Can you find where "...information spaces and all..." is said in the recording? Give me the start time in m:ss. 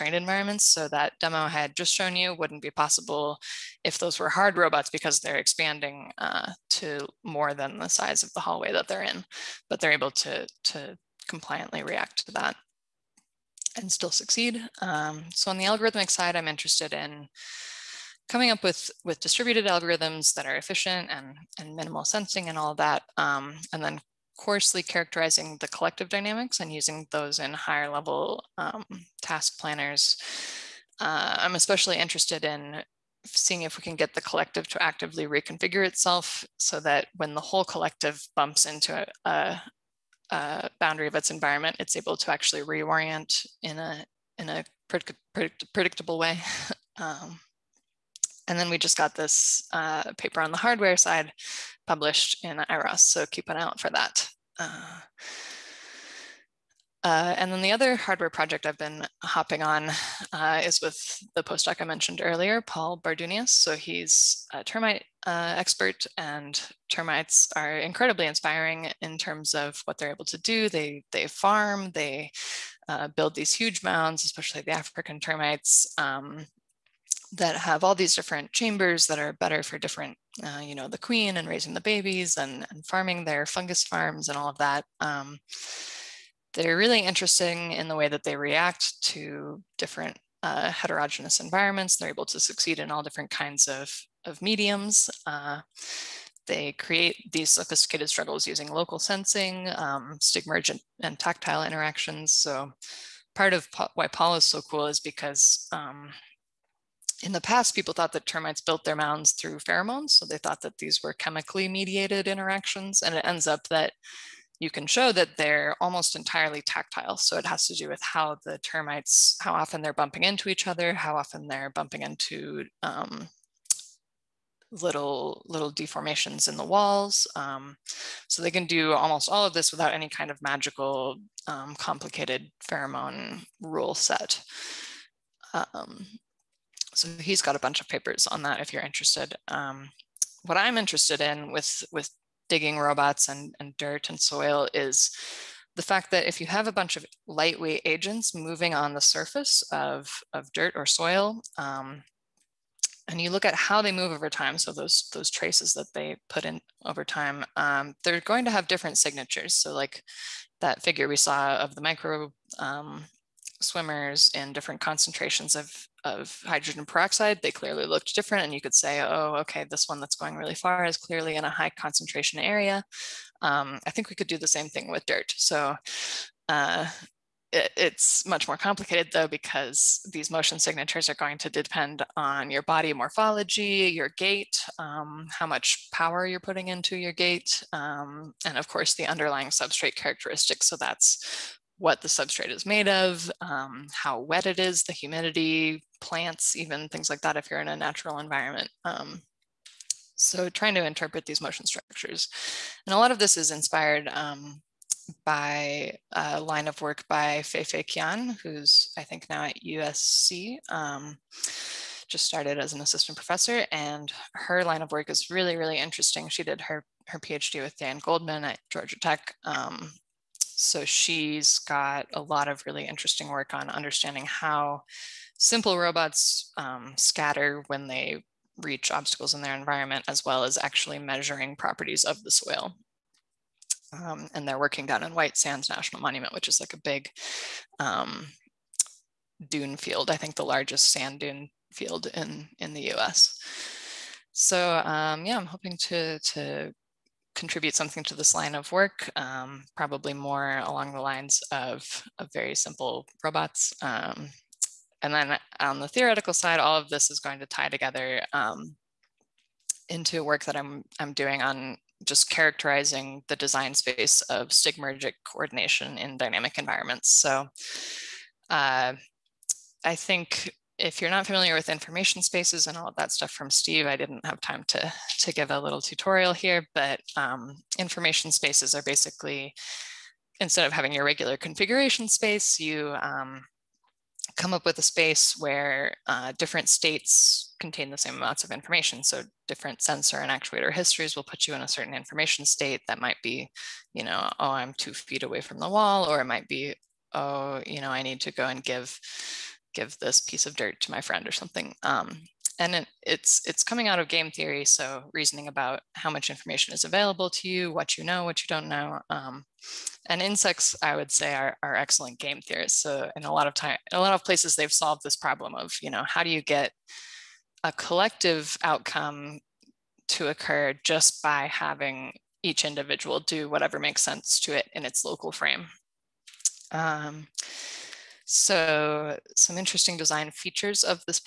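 4:31.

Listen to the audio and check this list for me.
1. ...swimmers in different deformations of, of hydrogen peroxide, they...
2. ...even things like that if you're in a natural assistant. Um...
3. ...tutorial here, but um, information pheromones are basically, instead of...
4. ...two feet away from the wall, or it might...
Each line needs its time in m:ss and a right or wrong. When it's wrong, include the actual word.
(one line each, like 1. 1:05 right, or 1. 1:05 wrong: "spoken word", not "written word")
1. 2:43 wrong: "concentrations", not "deformations"
2. 3:16 wrong: "environment", not "assistant"
3. 4:35 wrong: "spaces", not "pheromones"
4. 4:54 right.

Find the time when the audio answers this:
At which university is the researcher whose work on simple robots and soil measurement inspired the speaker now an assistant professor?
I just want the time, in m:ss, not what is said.
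3:29.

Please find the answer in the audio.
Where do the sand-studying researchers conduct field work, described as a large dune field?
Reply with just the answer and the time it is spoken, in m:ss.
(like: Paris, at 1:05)
White Sands National Monument, at 3:55.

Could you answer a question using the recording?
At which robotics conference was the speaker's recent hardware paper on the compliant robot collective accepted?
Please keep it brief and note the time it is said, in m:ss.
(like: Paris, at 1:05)
IROS, at 0:52.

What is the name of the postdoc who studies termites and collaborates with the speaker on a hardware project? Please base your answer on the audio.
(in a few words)
Paul Bardunias.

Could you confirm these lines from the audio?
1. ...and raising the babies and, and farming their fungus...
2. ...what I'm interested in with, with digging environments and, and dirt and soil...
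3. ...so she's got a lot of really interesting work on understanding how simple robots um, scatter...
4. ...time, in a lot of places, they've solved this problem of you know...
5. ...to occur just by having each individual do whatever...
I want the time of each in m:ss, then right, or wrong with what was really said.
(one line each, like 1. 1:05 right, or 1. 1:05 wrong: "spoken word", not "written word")
1. 1:21 right
2. 2:20 wrong: "robots", not "environments"
3. 3:40 right
4. 5:13 right
5. 5:20 right.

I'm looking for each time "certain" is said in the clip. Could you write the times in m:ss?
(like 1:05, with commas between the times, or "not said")
4:51.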